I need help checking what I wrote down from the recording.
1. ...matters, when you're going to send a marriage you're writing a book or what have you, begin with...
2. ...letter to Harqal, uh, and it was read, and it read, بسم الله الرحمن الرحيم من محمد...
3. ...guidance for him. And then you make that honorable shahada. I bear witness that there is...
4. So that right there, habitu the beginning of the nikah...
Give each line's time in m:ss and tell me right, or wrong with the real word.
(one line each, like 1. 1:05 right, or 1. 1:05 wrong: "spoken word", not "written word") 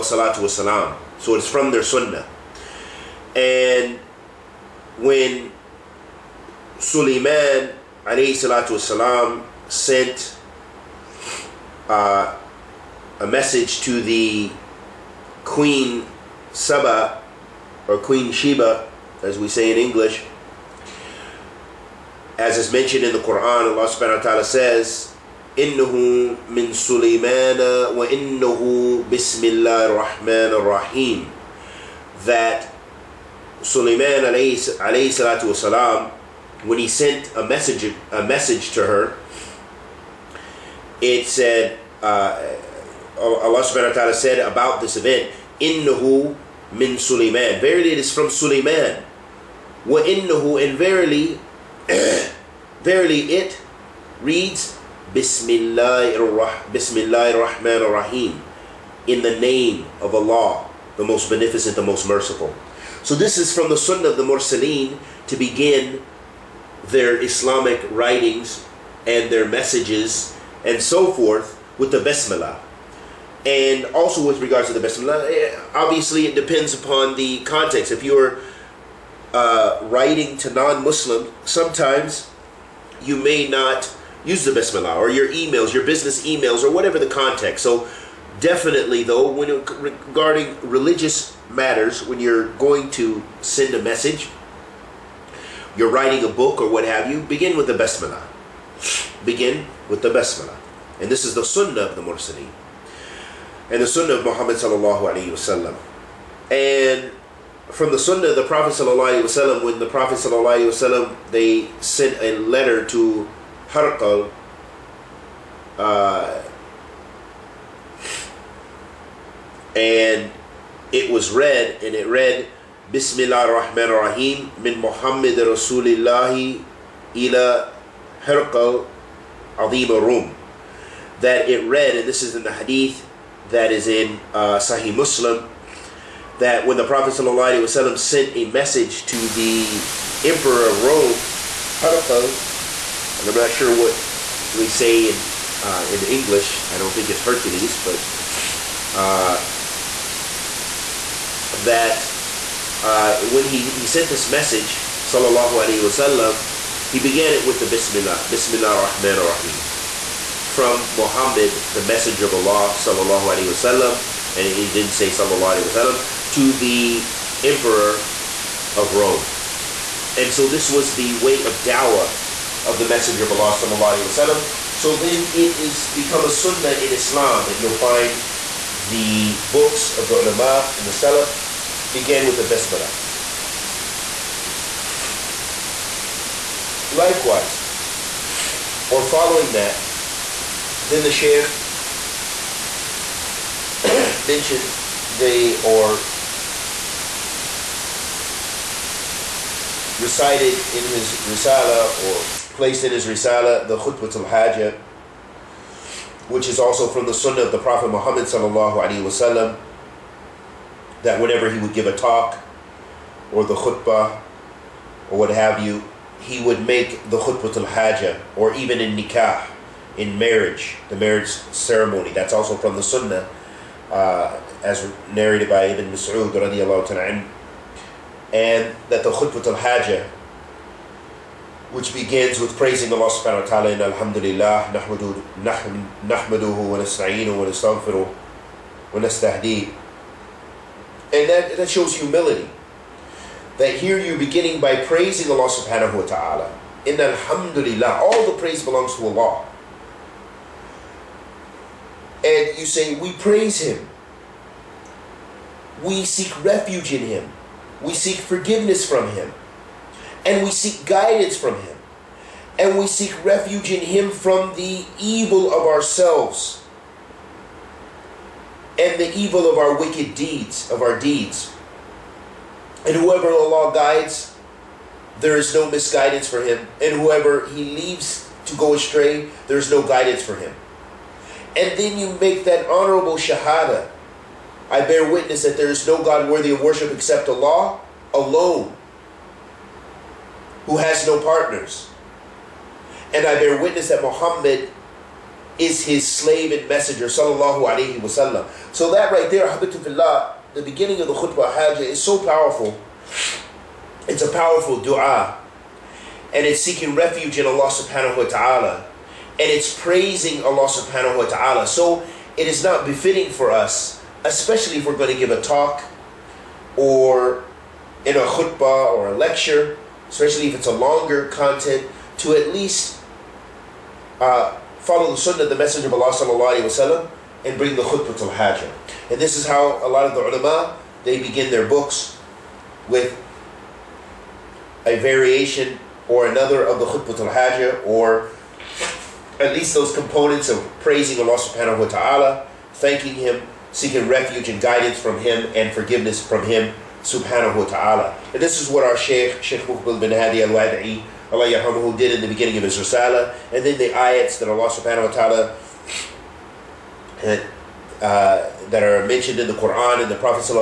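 1. 1:31 wrong: "message", not "marriage"
2. 1:52 right
3. 4:39 right
4. 4:58 wrong: "khutbah", not "nikah".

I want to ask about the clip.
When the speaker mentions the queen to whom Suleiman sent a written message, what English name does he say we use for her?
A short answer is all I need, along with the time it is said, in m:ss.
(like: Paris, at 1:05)
Queen Sheba, at 0:17.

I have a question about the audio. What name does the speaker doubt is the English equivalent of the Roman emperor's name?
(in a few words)
Hercules.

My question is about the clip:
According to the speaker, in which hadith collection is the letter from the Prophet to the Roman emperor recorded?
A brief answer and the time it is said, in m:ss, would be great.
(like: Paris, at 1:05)
Sahih Muslim, at 2:14.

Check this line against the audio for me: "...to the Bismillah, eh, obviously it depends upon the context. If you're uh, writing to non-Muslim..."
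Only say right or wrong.
right.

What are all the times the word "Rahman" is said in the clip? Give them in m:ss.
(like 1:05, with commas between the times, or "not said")
0:56, 2:38.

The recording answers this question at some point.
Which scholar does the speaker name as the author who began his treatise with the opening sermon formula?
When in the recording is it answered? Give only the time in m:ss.
5:49.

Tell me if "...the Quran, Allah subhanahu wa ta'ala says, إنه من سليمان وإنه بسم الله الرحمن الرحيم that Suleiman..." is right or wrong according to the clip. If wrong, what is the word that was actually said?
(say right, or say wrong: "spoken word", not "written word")
right.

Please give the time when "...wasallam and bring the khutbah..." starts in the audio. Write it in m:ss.
5:26.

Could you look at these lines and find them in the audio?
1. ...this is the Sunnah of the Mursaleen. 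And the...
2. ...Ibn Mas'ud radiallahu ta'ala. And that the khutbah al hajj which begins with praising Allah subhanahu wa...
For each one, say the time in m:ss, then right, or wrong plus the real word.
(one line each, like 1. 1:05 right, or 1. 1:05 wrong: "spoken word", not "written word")
1. 1:41 right
2. 3:45 right.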